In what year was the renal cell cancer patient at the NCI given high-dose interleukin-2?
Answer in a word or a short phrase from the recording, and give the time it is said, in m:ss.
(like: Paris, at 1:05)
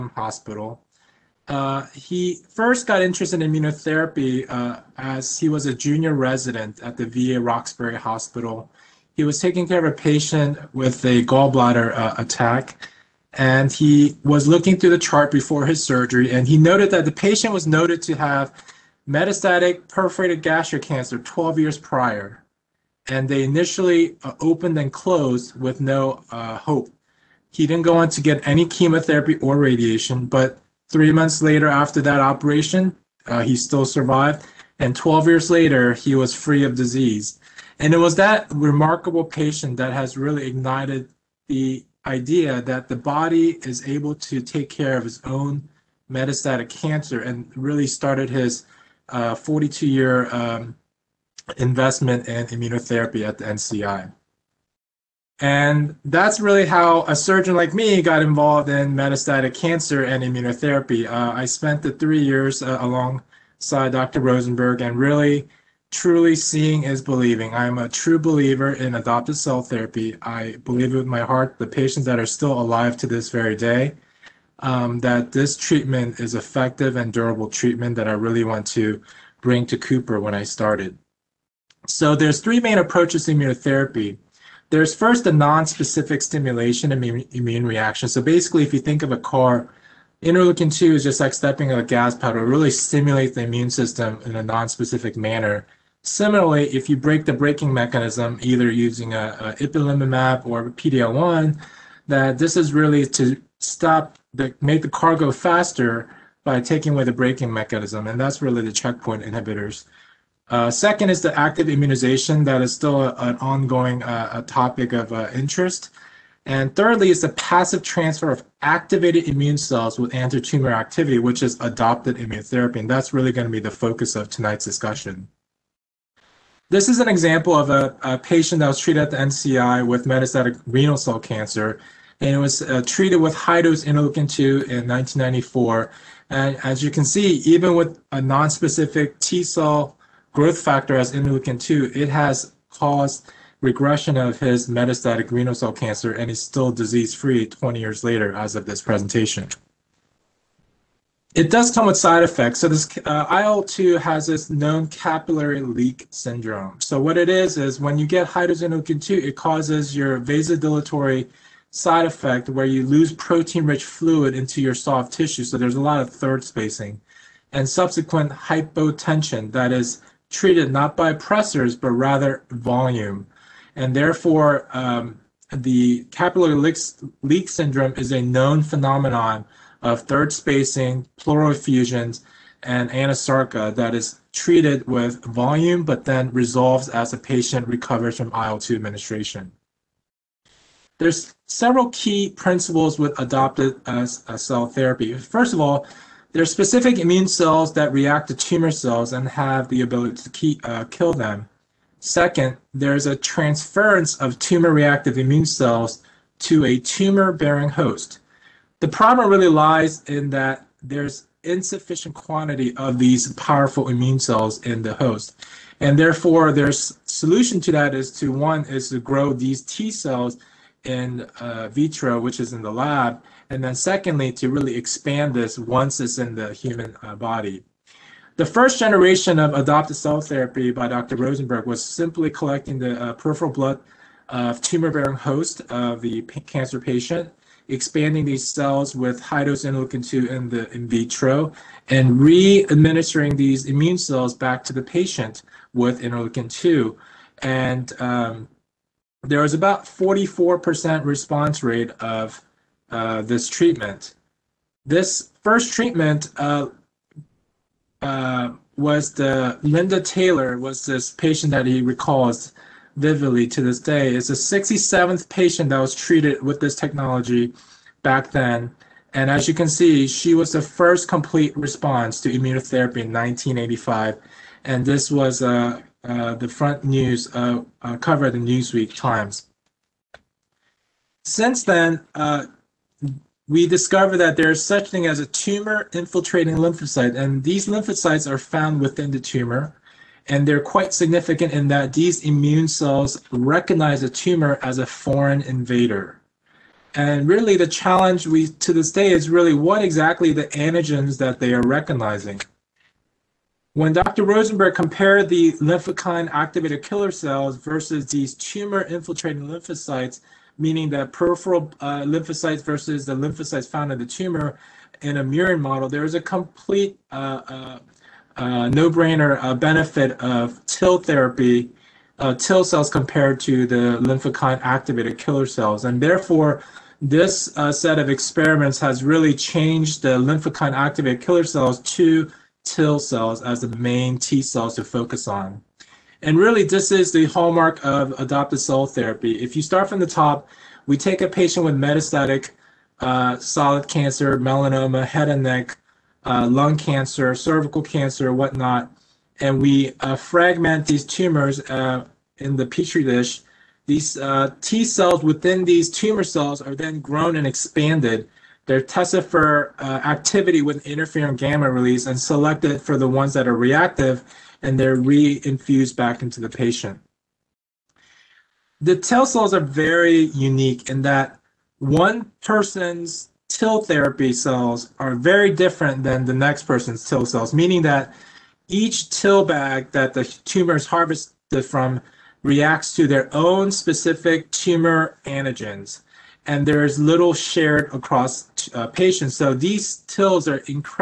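1994, at 2:14.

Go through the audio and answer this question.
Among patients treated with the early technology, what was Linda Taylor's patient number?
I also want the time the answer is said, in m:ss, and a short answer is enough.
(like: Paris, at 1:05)
67th, at 4:24.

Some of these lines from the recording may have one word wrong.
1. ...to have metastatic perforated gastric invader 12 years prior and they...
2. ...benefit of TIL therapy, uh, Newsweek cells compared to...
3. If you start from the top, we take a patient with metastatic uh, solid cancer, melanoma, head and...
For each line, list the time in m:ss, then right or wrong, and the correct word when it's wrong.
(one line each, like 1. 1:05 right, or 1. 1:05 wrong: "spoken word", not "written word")
1. 0:18 wrong: "cancer", not "invader"
2. 5:19 wrong: "TIL", not "Newsweek"
3. 5:39 right.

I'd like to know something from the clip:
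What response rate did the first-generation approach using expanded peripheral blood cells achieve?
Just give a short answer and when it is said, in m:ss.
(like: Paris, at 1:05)
44%, at 4:09.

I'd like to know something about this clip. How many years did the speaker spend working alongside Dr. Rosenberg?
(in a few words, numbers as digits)
3 years.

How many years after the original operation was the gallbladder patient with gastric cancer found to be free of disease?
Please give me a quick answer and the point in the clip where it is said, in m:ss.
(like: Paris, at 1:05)
12 years, at 0:34.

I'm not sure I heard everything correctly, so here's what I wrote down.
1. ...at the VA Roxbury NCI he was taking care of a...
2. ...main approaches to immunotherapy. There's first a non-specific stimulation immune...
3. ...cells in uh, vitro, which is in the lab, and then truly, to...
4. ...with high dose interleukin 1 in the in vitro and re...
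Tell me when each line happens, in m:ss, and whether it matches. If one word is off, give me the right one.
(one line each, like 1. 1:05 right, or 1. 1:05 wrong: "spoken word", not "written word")
1. 0:06 wrong: "Hospital", not "NCI"
2. 1:22 right
3. 3:39 wrong: "secondly", not "truly"
4. 3:58 wrong: "2", not "1".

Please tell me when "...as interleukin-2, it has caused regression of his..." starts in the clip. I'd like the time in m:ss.
2:20.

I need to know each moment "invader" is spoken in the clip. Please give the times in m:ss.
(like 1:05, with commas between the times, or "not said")
4:55.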